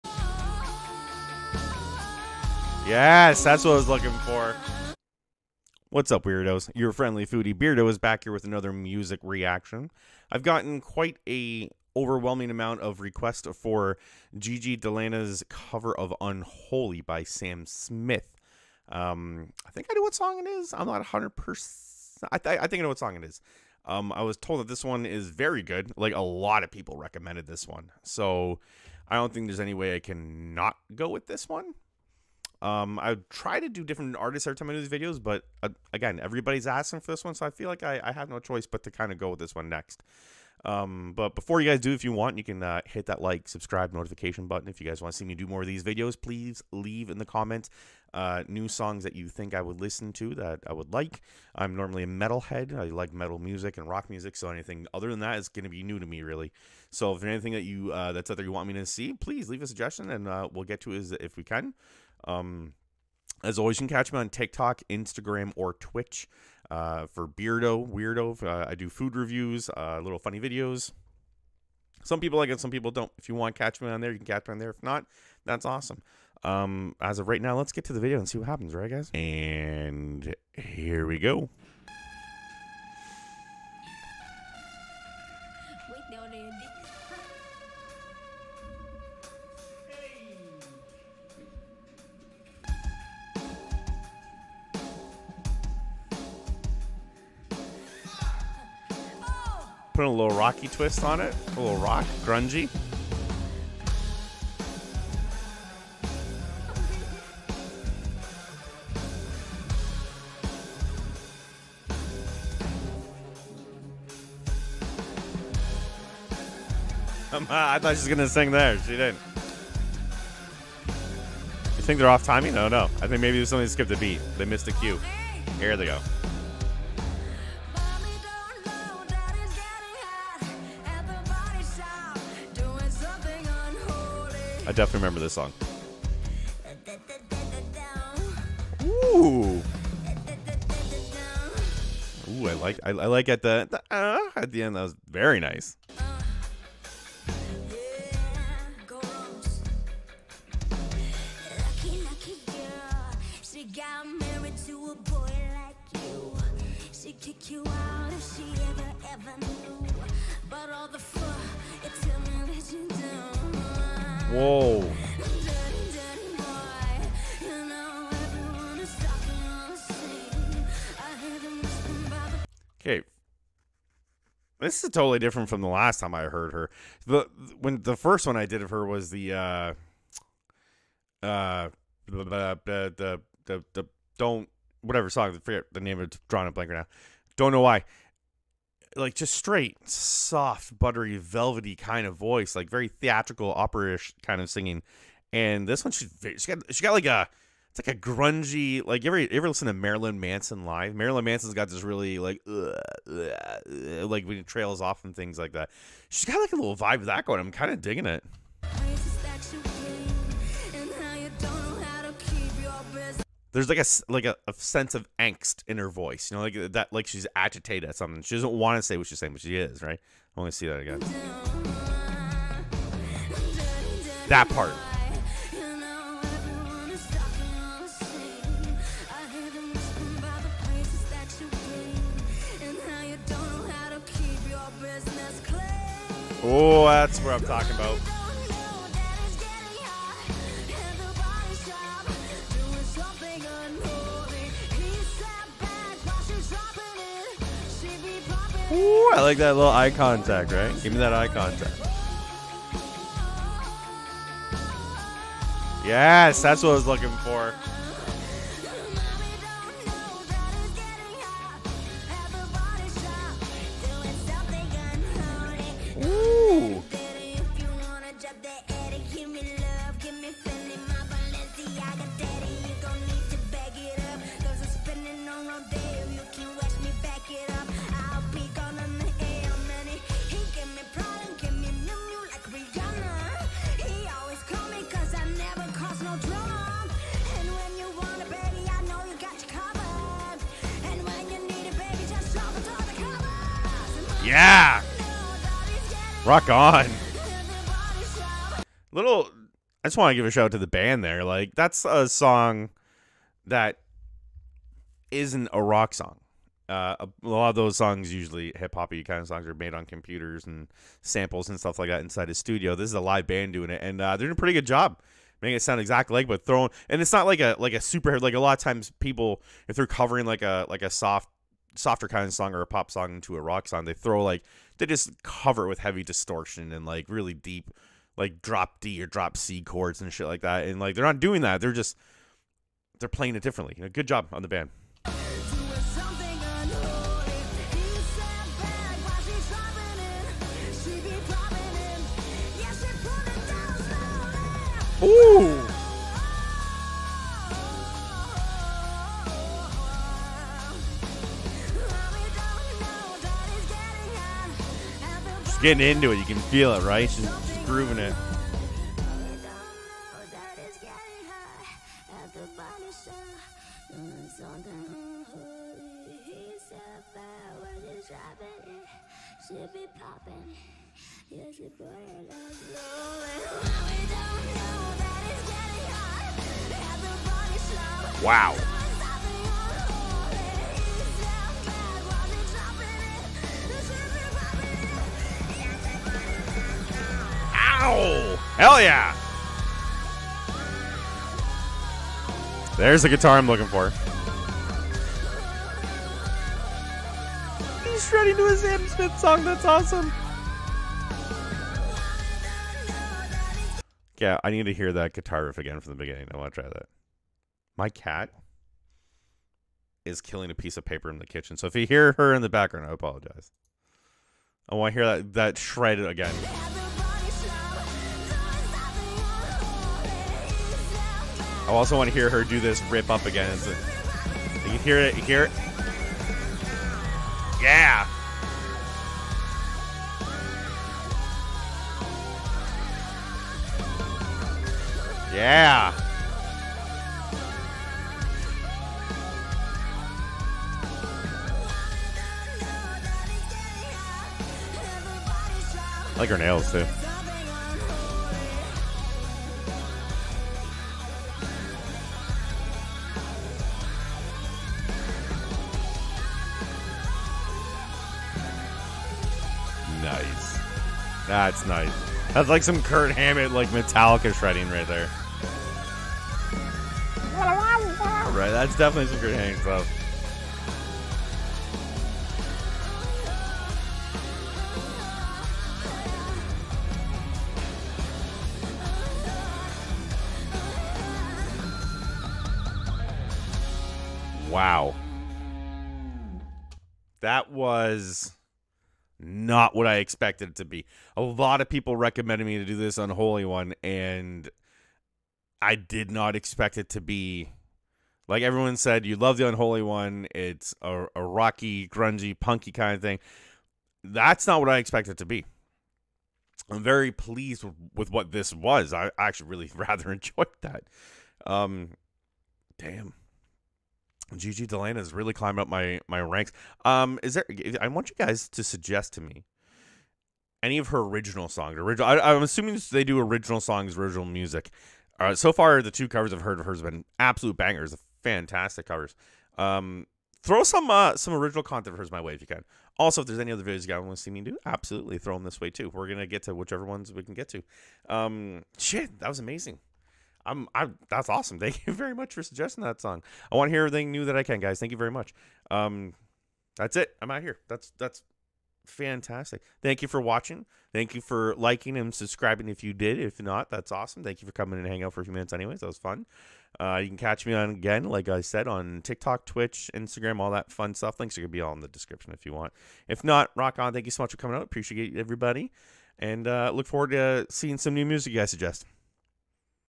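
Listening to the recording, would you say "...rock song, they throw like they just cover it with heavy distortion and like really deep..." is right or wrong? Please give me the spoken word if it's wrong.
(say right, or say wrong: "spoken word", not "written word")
right.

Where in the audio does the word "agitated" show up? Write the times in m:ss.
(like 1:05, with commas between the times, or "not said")
3:37.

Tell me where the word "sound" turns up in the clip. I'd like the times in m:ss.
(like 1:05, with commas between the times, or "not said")
5:15.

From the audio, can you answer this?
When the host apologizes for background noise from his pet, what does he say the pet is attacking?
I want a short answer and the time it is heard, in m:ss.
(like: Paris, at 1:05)
a piece of paper, at 6:50.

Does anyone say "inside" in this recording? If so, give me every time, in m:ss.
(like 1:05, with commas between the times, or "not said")
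5:12.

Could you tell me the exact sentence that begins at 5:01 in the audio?
Like that's a song that isn't a rock song.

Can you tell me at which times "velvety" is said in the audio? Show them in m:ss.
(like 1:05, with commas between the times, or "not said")
3:11.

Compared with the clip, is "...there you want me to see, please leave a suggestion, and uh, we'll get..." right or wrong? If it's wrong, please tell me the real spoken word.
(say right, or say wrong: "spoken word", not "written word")
right.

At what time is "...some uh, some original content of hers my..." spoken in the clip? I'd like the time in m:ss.
8:50.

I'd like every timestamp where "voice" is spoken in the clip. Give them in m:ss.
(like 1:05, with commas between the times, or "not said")
3:12, 3:35.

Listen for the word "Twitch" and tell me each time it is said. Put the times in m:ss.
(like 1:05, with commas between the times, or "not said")
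1:05, 9:19.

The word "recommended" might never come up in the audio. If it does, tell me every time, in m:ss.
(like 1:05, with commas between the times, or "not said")
0:26, 8:11.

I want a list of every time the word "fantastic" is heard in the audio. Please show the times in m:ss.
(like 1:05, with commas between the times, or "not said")
8:48, 9:08.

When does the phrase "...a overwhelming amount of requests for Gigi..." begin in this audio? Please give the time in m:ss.
0:11.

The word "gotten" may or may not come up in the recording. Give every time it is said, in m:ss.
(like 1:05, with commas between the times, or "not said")
0:10.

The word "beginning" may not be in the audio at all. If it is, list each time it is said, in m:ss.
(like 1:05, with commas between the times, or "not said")
6:45.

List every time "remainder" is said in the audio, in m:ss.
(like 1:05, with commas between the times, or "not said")
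not said.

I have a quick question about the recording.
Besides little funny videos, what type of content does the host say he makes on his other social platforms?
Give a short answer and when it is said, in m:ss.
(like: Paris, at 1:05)
food reviews, at 1:08.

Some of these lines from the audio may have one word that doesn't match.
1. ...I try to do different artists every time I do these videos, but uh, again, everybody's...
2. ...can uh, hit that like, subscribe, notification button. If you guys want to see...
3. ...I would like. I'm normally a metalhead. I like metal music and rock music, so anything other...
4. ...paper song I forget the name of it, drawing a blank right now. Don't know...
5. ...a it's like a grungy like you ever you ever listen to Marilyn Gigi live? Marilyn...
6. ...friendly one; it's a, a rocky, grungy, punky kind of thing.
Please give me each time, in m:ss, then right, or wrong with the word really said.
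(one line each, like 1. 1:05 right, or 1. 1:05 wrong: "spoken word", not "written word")
1. 0:32 right
2. 0:42 right
3. 0:50 right
4. 3:04 wrong: "whatever", not "paper"
5. 3:17 wrong: "Manson", not "Gigi"
6. 8:19 wrong: "unholy", not "friendly".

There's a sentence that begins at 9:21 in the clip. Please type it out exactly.
Links are going to be all in the description if you want.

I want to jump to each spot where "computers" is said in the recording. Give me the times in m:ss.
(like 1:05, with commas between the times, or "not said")
5:09.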